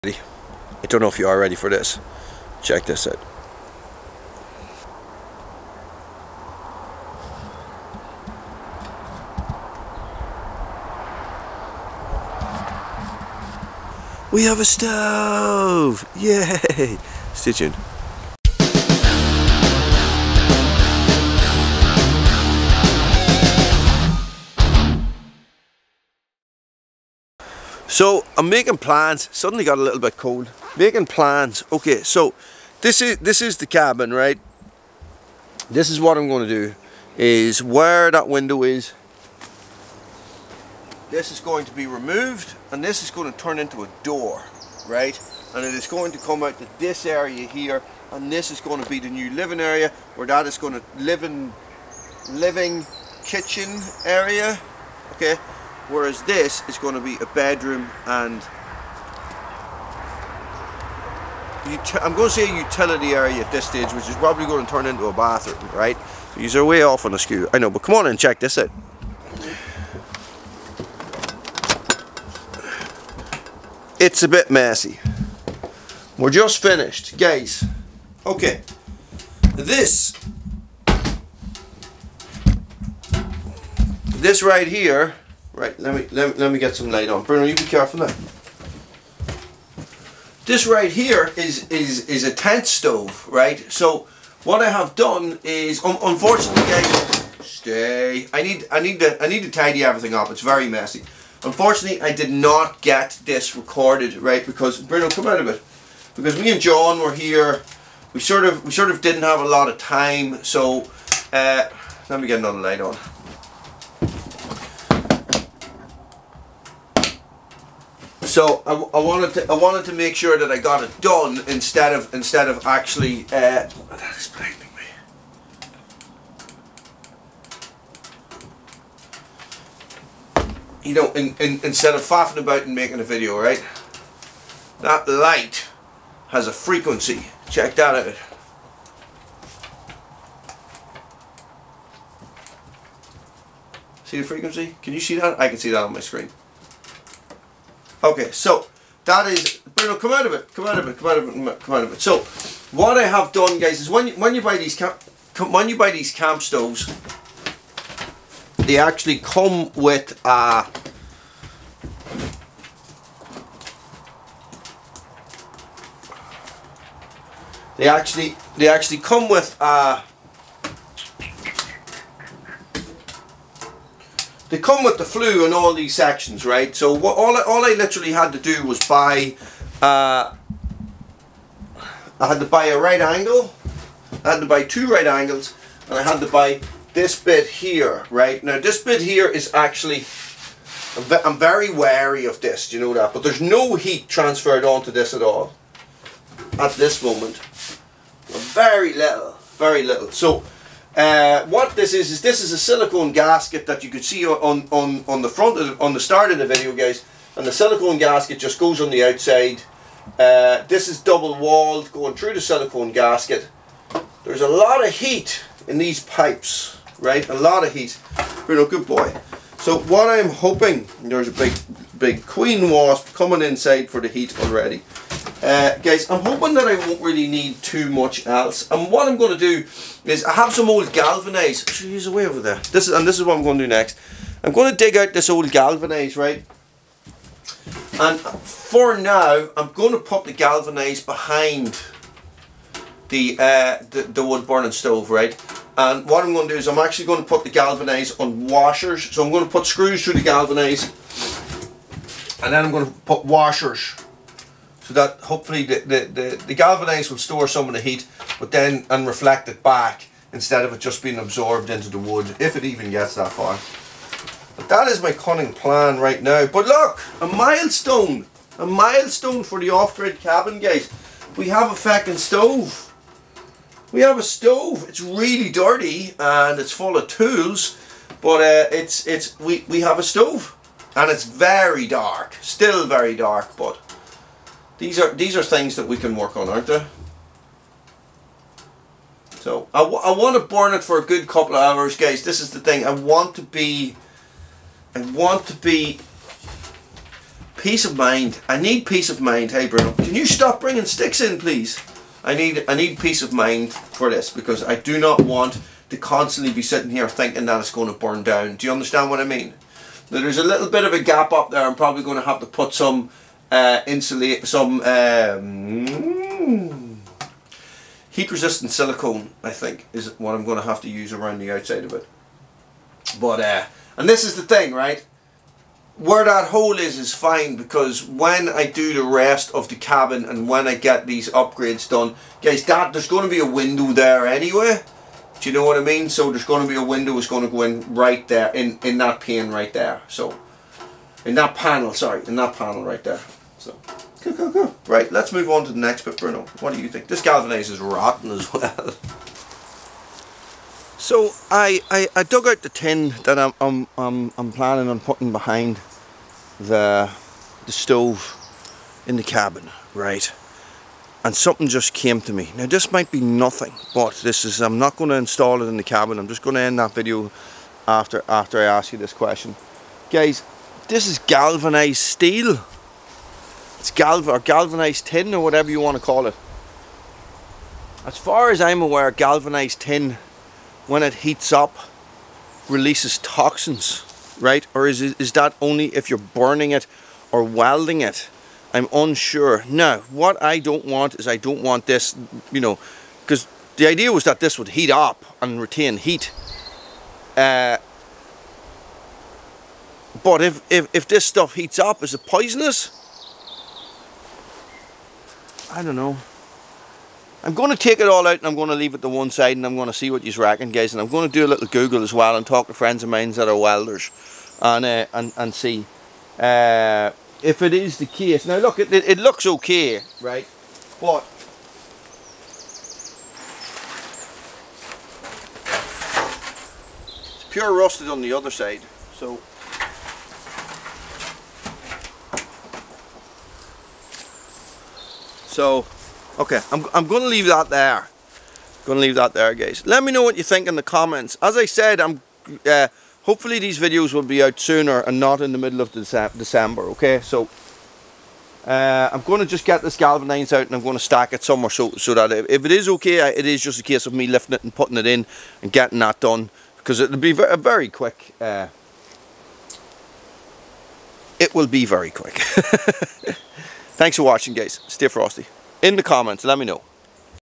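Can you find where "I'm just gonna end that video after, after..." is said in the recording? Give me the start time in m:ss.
6:06.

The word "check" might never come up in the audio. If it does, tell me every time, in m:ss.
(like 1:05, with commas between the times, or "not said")
0:02, 1:08, 2:17.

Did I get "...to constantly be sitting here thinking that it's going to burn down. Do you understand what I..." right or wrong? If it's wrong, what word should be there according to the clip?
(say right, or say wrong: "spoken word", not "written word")
right.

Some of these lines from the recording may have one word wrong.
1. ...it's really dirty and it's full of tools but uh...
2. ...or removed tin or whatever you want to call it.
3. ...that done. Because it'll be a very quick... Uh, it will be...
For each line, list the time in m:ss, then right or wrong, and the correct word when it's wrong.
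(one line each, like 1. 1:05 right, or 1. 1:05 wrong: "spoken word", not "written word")
1. 4:34 right
2. 6:14 wrong: "galvanized", not "removed"
3. 7:35 right.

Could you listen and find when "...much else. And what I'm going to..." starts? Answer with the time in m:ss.
3:47.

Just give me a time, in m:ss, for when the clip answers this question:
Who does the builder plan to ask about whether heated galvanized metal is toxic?
6:53.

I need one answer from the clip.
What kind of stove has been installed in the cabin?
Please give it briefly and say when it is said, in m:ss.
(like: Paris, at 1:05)
tent stove, at 1:32.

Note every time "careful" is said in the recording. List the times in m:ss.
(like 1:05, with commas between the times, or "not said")
1:27.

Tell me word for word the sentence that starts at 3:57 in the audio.
And for now, I'm going to put the galvanized behind the, uh, the, the wood burning stove, right?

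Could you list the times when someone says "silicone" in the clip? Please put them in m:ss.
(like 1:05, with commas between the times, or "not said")
3:22, 3:27, 3:32, 5:18.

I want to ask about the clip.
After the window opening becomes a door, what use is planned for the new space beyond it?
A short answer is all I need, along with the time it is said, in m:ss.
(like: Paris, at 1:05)
living kitchen area, at 0:52.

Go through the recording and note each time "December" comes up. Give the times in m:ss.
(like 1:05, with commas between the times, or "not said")
7:25.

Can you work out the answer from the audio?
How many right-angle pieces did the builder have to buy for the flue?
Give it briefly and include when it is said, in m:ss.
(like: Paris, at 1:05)
2, at 3:04.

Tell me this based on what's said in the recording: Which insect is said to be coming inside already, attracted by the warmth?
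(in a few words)
queen wasp.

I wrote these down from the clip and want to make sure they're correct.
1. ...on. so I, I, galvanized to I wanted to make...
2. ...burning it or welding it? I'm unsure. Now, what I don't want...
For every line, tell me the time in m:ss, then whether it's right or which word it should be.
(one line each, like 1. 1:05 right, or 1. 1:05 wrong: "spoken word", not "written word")
1. 1:52 wrong: "wanted", not "galvanized"
2. 6:26 right.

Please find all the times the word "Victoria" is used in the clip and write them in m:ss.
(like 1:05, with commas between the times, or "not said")
not said.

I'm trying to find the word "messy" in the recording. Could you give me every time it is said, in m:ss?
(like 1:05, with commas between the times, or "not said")
1:14, 1:40.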